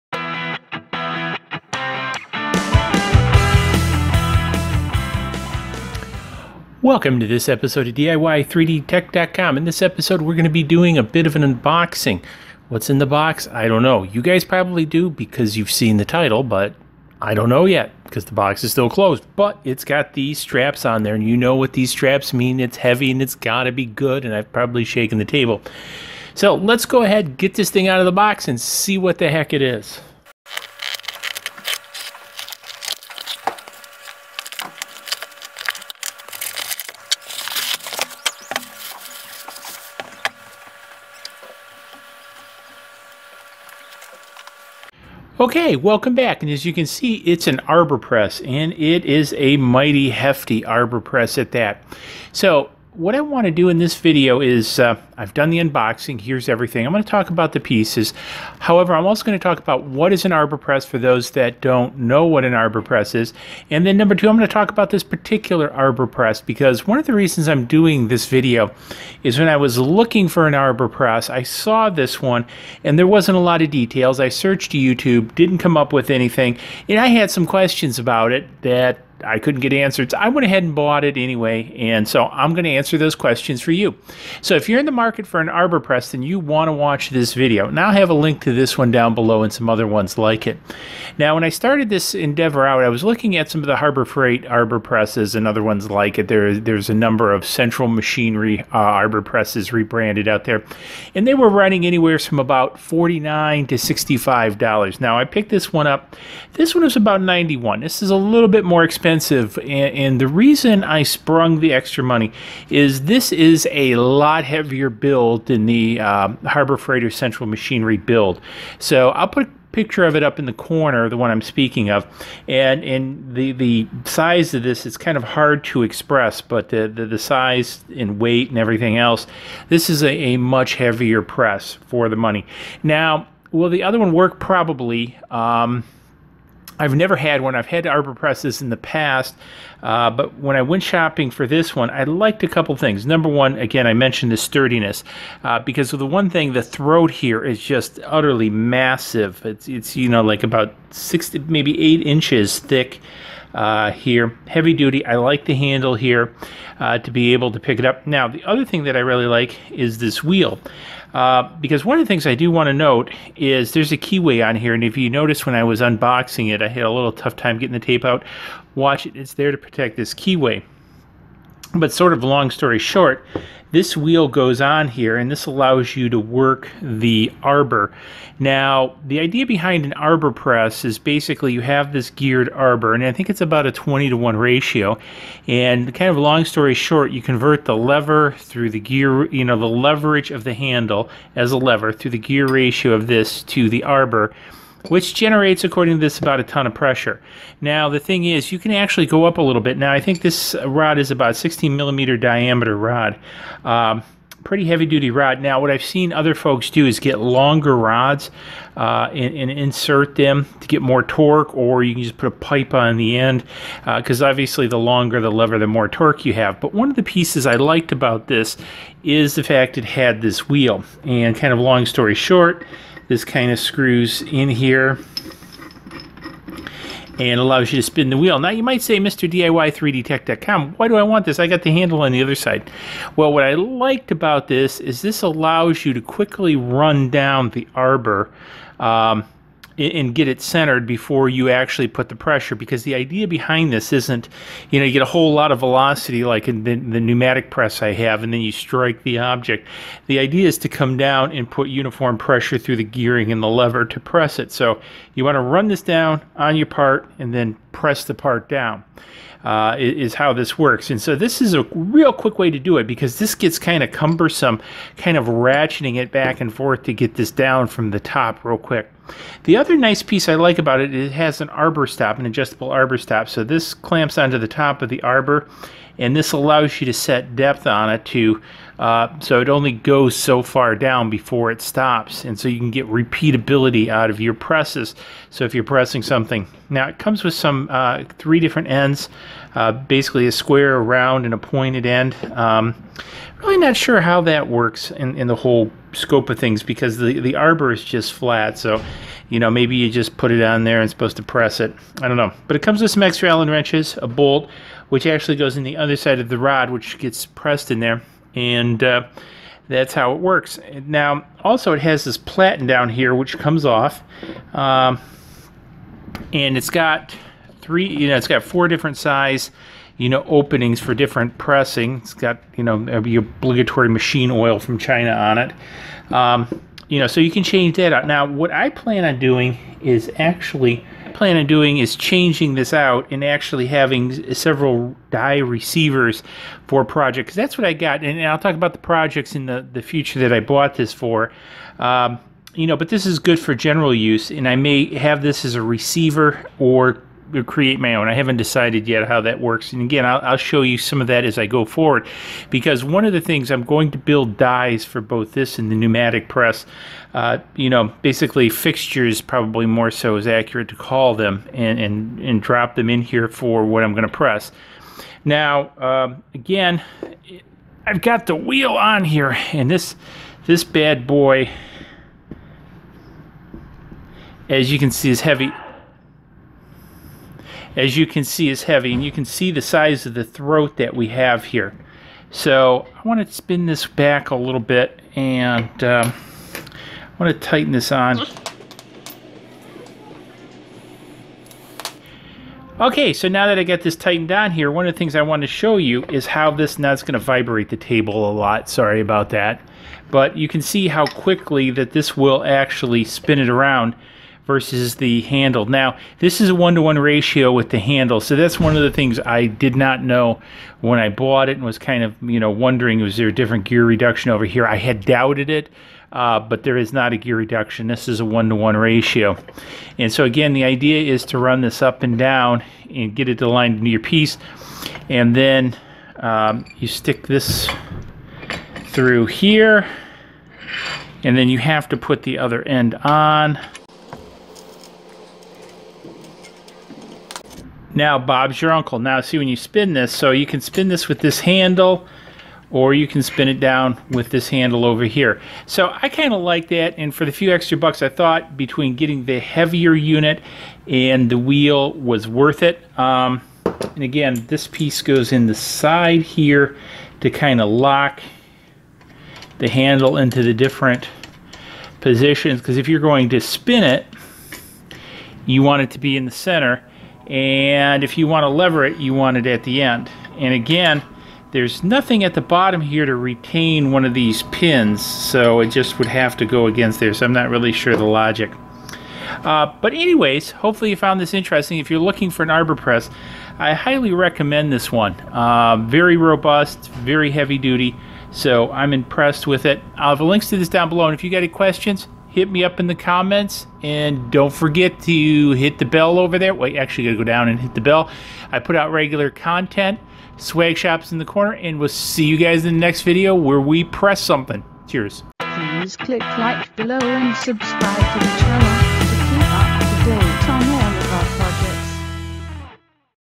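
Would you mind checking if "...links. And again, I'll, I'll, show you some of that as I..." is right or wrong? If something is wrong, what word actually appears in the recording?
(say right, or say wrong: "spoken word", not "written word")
wrong: "works", not "links".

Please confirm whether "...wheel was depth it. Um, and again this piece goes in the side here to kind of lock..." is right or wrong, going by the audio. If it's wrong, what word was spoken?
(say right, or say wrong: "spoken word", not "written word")
wrong: "worth", not "depth".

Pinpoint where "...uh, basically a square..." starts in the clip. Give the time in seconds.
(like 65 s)
289 s.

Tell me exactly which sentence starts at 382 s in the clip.
So I want to spin this back a little bit and um, I want to tighten this on.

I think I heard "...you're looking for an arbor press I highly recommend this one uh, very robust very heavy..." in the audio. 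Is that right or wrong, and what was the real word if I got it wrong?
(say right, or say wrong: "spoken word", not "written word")
right.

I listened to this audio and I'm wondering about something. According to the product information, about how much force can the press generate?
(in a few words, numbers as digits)
a ton.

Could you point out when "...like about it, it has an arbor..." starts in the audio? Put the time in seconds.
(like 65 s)
270 s.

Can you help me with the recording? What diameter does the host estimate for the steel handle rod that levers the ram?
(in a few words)
16 millimeter.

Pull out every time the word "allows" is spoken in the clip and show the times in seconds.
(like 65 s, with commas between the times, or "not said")
175 s, 227 s, 235 s, 276 s.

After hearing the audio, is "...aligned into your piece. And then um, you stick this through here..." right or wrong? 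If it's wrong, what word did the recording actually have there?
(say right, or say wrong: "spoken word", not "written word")
right.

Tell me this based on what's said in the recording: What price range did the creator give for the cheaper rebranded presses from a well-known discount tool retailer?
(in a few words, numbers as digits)
49 to $65.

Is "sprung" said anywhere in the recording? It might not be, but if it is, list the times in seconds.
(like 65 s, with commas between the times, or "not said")
111 s.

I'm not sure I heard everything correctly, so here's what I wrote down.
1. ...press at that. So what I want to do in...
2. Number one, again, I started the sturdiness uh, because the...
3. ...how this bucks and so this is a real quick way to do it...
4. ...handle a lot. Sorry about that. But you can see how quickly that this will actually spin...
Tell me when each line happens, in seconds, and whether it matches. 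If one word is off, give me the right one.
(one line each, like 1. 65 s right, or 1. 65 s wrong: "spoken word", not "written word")
1. 51 s right
2. 143 s wrong: "mentioned", not "started"
3. 260 s wrong: "works", not "bucks"
4. 397 s wrong: "table", not "handle".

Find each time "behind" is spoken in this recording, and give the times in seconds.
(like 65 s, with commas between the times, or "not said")
179 s, 243 s.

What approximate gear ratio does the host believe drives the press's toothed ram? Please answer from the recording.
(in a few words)
20 to 1.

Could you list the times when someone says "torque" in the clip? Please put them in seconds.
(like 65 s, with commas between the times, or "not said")
211 s, 215 s.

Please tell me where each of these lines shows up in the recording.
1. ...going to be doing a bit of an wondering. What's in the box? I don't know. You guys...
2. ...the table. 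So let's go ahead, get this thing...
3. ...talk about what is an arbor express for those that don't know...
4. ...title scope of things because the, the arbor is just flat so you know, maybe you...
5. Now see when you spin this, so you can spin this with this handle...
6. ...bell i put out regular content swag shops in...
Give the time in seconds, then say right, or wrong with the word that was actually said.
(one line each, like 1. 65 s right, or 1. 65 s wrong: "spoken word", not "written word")
1. 10 s wrong: "unboxing", not "wondering"
2. 25 s right
3. 59 s wrong: "press", not "express"
4. 295 s wrong: "whole", not "title"
5. 438 s right
6. 497 s right.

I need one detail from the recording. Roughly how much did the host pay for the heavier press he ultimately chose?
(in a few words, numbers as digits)
91.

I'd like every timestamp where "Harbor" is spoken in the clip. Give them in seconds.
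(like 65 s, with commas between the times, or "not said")
93 s, 116 s.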